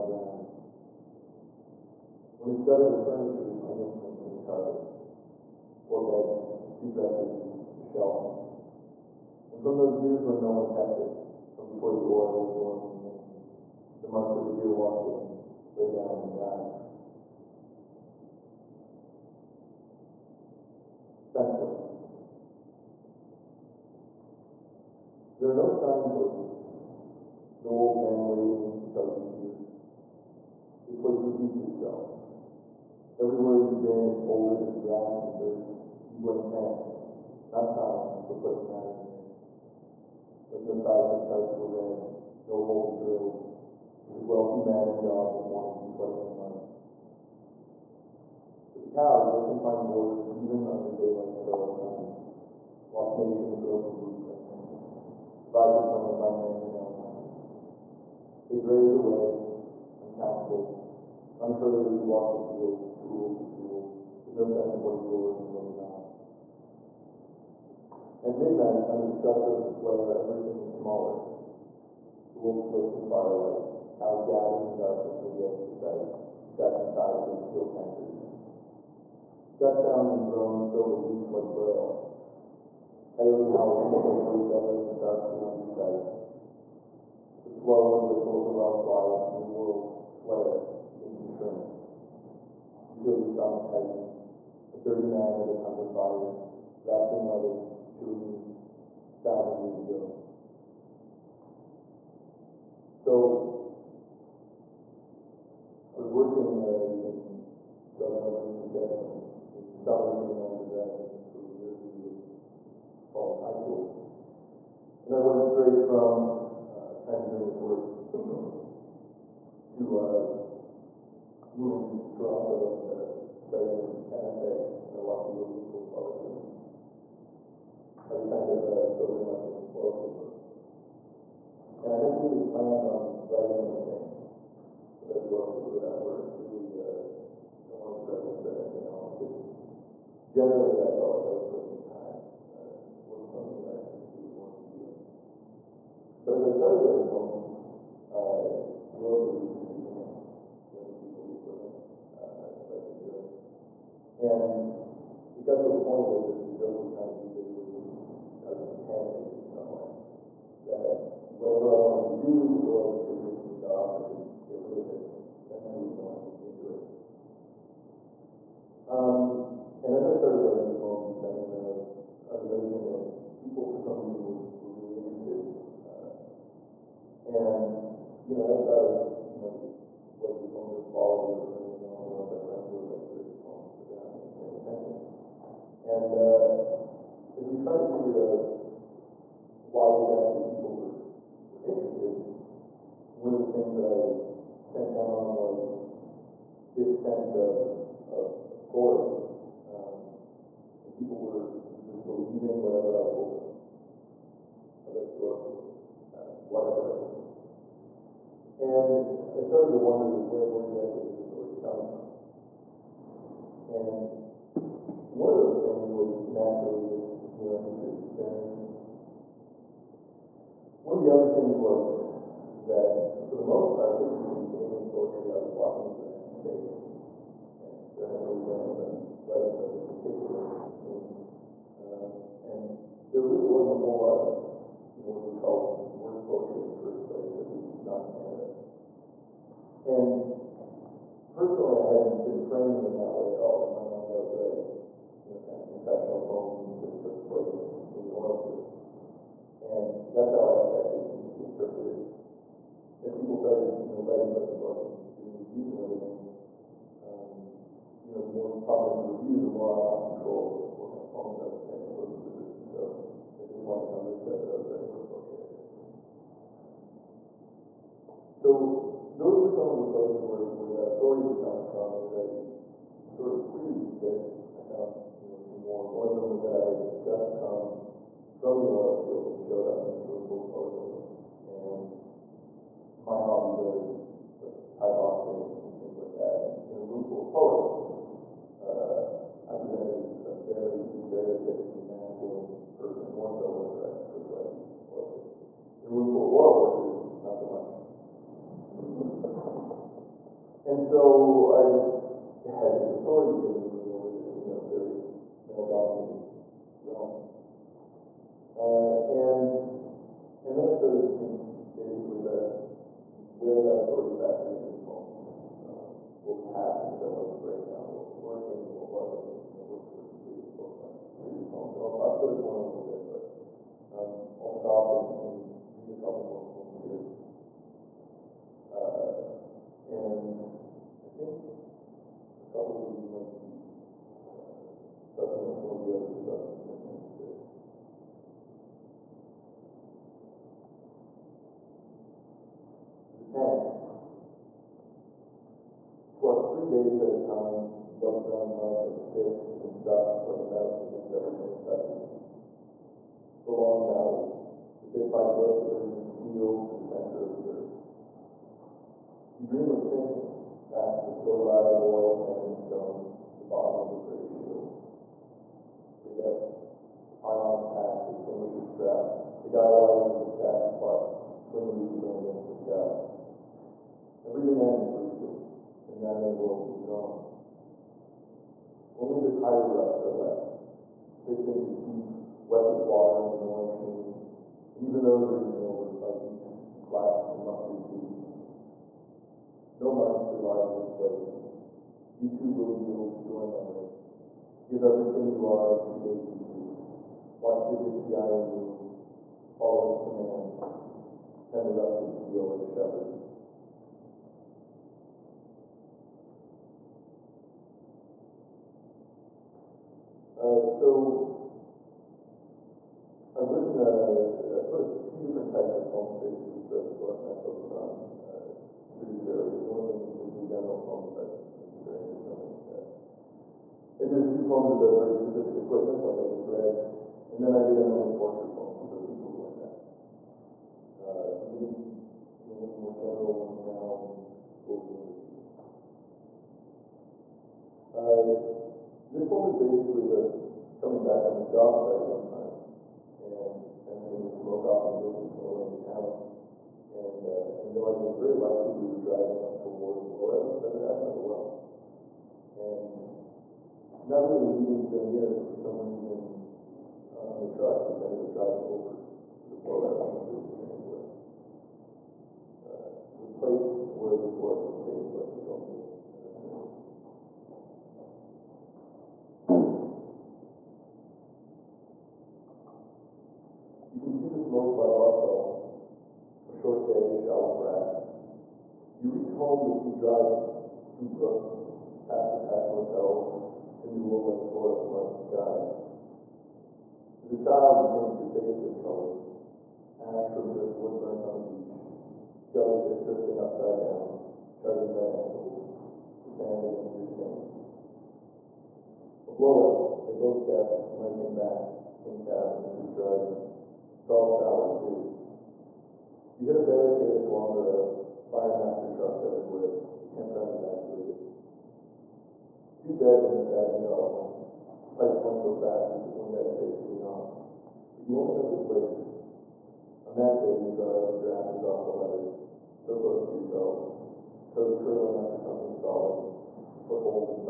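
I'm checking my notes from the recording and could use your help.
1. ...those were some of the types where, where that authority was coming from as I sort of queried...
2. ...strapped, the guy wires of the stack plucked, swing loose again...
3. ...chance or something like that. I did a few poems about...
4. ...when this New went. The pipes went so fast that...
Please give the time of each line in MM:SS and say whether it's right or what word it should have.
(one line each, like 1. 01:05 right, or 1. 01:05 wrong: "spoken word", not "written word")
1. 04:29 wrong: "places", not "types"
2. 06:08 right
3. 07:01 wrong: "experience", not "chance"
4. 08:33 wrong: "Abingdon", not "New".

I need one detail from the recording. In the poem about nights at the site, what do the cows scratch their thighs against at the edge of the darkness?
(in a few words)
steel tankers.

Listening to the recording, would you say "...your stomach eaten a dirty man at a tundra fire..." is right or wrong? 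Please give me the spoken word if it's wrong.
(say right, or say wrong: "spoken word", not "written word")
wrong: "tighten", not "eaten".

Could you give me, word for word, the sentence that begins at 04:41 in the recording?
And my hobbies are like Thai boxing and things like that.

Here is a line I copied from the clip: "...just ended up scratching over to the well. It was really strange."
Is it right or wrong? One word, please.
wrong.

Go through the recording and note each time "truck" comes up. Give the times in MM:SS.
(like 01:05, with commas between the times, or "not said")
07:37, 08:28.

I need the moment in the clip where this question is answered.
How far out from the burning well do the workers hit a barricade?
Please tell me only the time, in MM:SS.
08:27.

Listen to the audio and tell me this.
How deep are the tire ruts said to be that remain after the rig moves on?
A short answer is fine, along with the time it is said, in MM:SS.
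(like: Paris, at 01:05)
6 inches, at 06:21.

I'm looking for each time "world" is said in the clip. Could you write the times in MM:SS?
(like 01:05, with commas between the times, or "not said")
01:29, 06:16.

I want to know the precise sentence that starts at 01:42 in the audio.
So, I was working uh, in southern Oregon, Saskatchewan, in the summer here in undergrad, for a year usually, following high school.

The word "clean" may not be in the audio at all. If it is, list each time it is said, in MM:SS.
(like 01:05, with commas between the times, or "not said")
08:36.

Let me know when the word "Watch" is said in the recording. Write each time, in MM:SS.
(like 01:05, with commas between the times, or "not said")
00:52, 06:37.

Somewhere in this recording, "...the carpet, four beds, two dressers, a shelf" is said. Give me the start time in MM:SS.
00:04.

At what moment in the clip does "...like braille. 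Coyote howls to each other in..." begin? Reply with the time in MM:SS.
01:21.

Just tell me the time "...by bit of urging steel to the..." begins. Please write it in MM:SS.
05:55.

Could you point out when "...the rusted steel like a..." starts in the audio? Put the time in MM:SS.
06:41.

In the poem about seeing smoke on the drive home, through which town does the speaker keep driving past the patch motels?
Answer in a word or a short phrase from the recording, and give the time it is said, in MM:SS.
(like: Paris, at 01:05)
Brooks, at 08:01.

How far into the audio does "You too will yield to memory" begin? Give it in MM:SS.
06:32.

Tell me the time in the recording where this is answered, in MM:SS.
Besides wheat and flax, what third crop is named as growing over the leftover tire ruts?
06:27.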